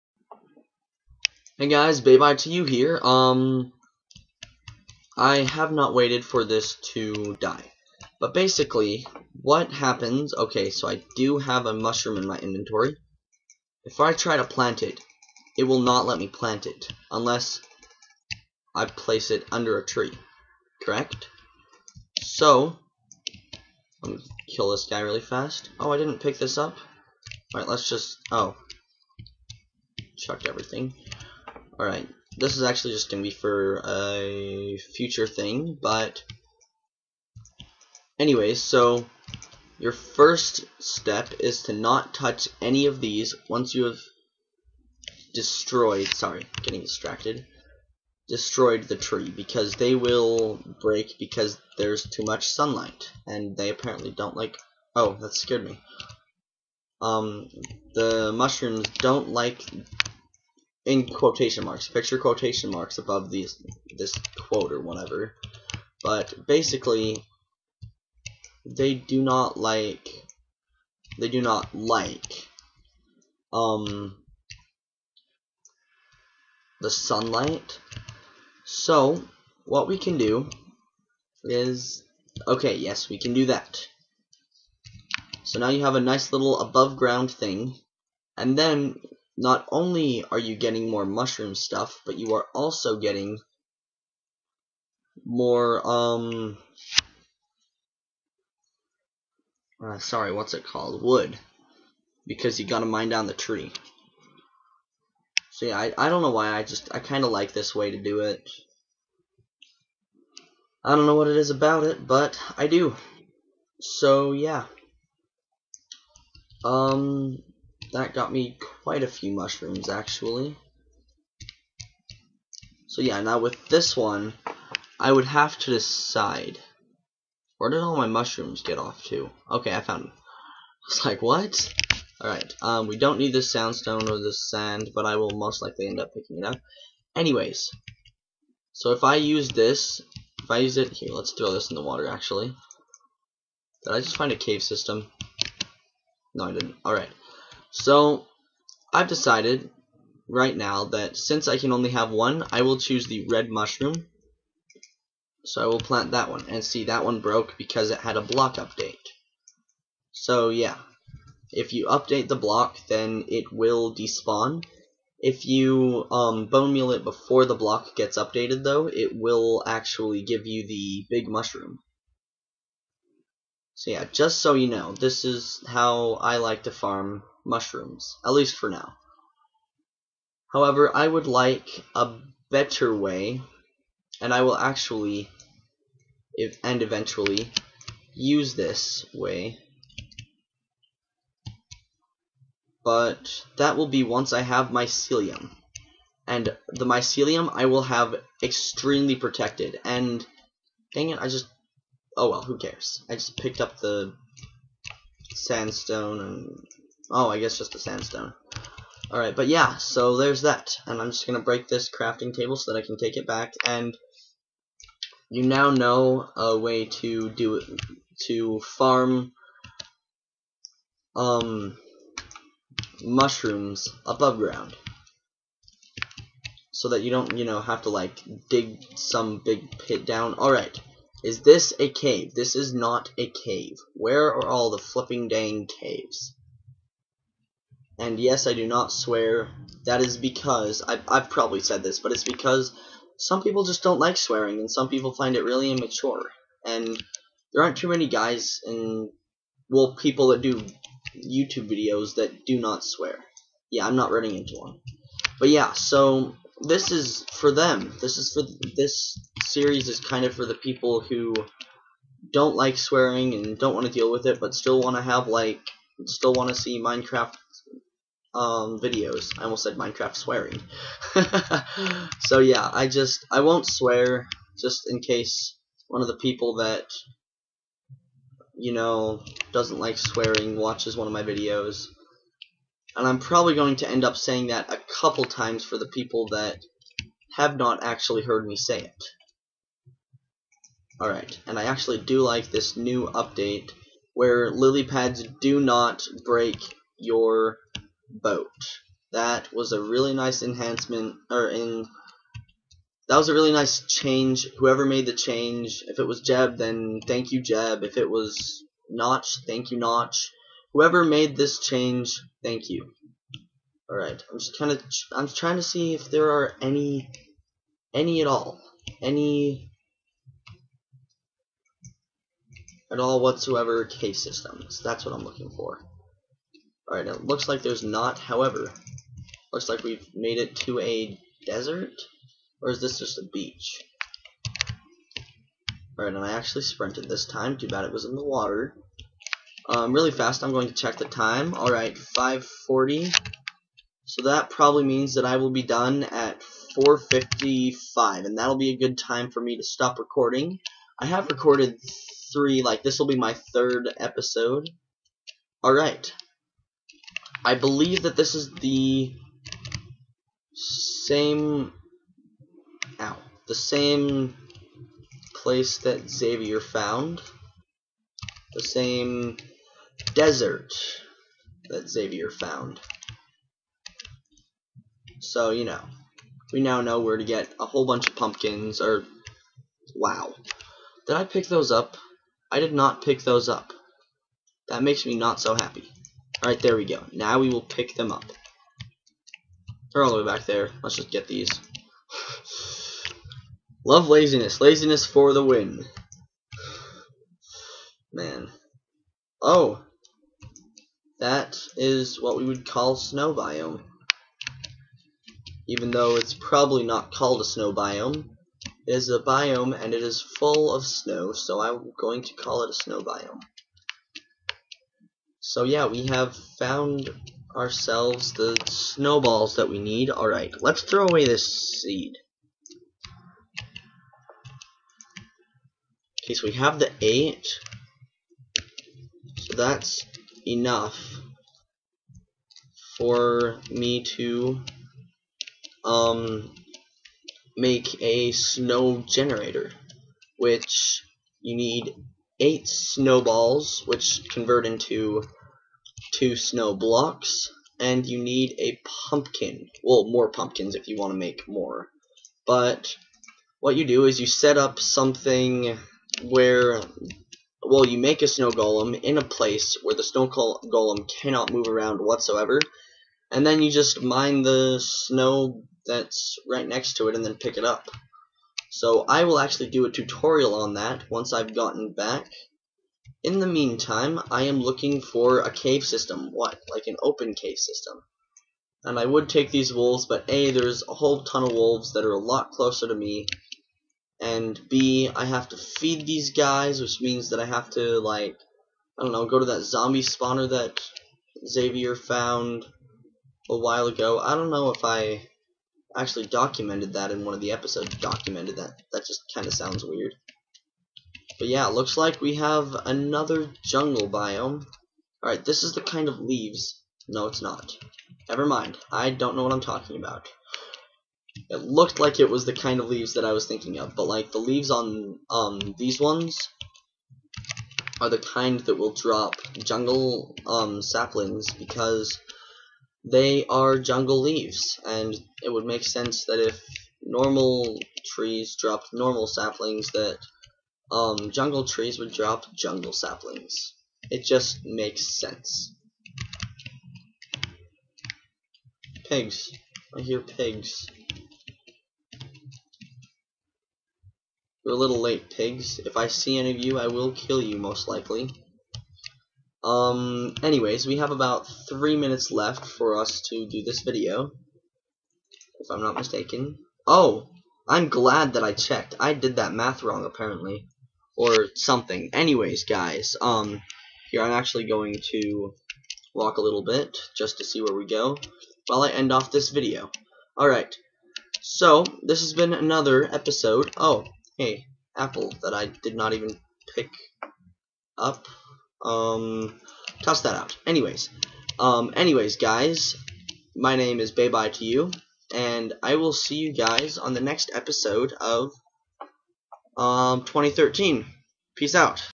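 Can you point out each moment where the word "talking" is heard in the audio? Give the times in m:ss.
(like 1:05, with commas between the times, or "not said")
8:29.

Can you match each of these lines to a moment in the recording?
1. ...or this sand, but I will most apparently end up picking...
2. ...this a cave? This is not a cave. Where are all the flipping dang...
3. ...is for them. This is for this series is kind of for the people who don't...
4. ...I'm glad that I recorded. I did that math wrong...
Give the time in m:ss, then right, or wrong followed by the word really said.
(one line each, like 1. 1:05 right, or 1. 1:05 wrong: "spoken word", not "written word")
1. 2:14 wrong: "likely", not "apparently"
2. 3:51 right
3. 4:16 right
4. 9:17 wrong: "checked", not "recorded".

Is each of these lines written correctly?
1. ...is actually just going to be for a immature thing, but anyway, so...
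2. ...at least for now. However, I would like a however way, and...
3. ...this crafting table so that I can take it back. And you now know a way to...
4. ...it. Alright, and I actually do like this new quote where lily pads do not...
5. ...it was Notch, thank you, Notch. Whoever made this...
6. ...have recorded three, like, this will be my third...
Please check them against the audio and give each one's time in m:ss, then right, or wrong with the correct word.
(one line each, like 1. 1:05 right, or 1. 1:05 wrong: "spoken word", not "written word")
1. 0:32 wrong: "future", not "immature"
2. 2:58 wrong: "better", not "however"
3. 3:31 right
4. 4:48 wrong: "update", not "quote"
5. 5:07 right
6. 5:51 right.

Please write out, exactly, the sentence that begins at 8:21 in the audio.
But yeah, looks like we have another jungle biome.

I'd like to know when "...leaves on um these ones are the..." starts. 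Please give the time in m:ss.
8:34.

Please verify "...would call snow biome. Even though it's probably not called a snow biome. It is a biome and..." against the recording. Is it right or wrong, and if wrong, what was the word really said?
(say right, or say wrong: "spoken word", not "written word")
right.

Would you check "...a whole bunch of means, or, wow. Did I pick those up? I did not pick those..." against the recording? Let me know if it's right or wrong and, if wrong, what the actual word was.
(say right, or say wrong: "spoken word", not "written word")
wrong: "pumpkins", not "means".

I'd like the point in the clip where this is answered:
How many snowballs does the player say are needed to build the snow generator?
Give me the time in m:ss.
7:22.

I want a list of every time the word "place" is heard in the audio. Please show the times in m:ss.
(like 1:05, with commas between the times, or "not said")
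0:18, 6:05, 7:39.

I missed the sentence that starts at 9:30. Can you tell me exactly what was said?
Alright, so this has been another episode.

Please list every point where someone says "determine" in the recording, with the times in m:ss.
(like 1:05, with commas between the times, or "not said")
not said.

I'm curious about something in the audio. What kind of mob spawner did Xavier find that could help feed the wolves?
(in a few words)
Zombie spawner.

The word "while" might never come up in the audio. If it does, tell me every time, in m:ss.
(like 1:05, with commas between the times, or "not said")
8:13, 9:28.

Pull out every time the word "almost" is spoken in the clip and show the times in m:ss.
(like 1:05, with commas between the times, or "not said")
4:29.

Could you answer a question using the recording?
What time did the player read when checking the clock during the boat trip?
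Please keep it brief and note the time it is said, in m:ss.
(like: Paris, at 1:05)
5:40, at 5:41.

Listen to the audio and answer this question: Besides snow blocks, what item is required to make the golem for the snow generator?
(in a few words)
A pumpkin.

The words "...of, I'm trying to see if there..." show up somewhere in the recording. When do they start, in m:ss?
5:14.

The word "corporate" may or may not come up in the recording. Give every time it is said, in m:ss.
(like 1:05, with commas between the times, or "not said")
not said.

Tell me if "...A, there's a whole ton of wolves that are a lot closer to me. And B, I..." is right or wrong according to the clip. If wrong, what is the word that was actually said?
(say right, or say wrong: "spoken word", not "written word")
right.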